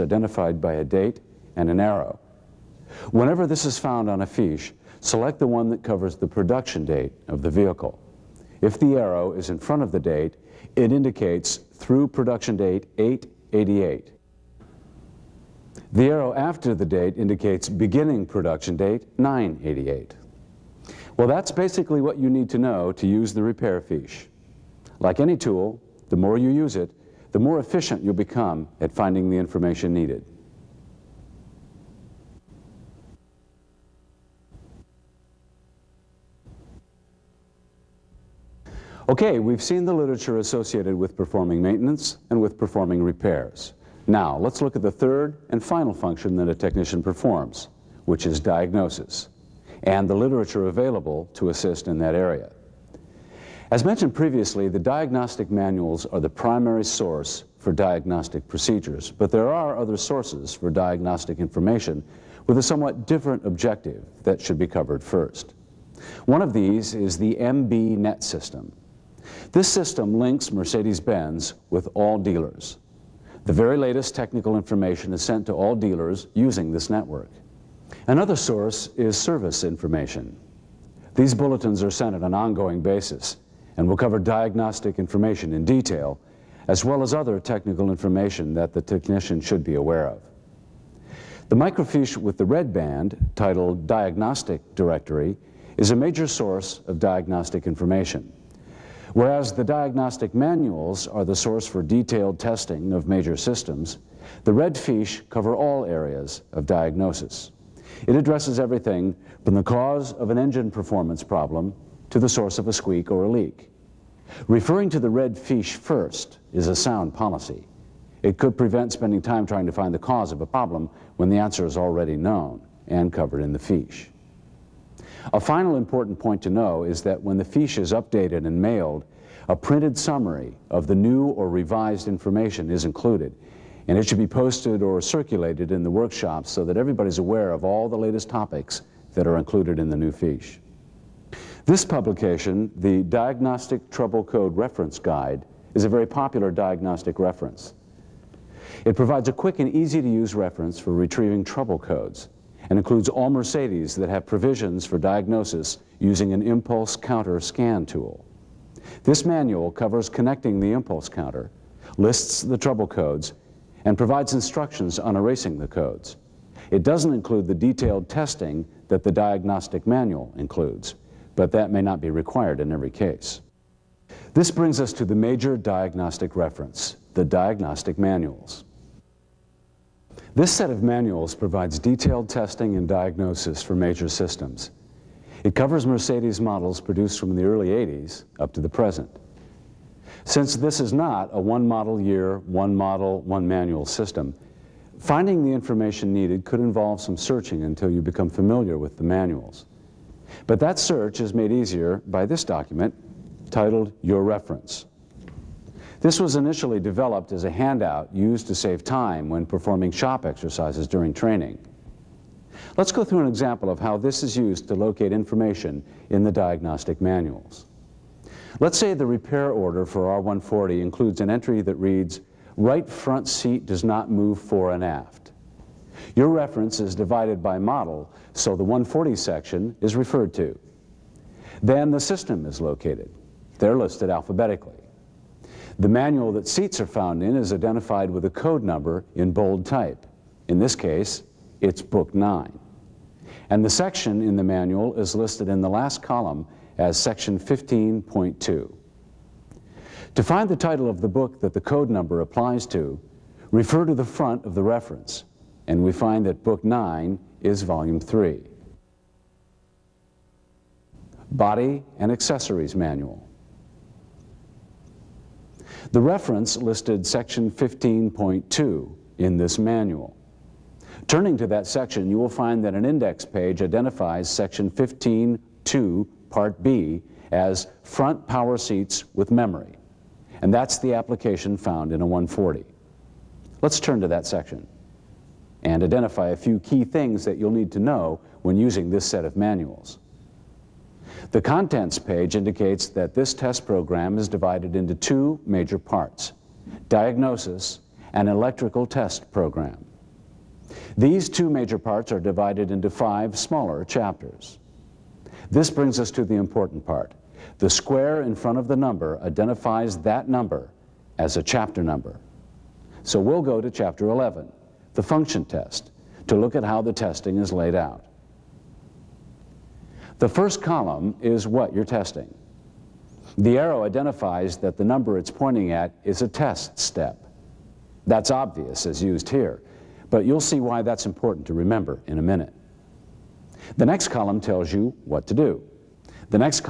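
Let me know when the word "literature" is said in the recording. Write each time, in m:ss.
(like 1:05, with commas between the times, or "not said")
0:39, 0:50.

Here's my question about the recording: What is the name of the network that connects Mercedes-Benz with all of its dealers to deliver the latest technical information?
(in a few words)
MBNet.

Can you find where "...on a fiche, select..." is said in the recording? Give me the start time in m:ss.
0:04.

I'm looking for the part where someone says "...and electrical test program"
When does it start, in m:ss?
4:58.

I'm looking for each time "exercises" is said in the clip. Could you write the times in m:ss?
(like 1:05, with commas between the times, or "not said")
3:30.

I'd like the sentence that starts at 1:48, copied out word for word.
It addresses everything from the cause of an engine performance problem to the source of a squeak or a leak.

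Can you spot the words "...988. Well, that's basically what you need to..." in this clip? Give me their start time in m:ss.
0:19.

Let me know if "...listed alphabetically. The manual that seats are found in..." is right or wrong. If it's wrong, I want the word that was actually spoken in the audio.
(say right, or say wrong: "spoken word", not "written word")
right.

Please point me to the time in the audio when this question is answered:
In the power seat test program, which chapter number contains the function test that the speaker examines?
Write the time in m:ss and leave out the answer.
5:13.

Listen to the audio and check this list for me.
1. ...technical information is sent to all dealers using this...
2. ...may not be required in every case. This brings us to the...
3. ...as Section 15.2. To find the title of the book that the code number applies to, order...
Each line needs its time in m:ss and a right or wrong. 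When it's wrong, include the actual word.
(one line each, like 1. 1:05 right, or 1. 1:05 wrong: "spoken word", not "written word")
1. 1:14 right
2. 2:51 right
3. 4:06 wrong: "refer", not "order".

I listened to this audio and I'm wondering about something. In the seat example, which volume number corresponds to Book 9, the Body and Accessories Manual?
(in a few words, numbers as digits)
Volume 3.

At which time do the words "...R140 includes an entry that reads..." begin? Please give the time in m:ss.
3:40.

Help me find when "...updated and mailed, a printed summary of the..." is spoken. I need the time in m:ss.
2:07.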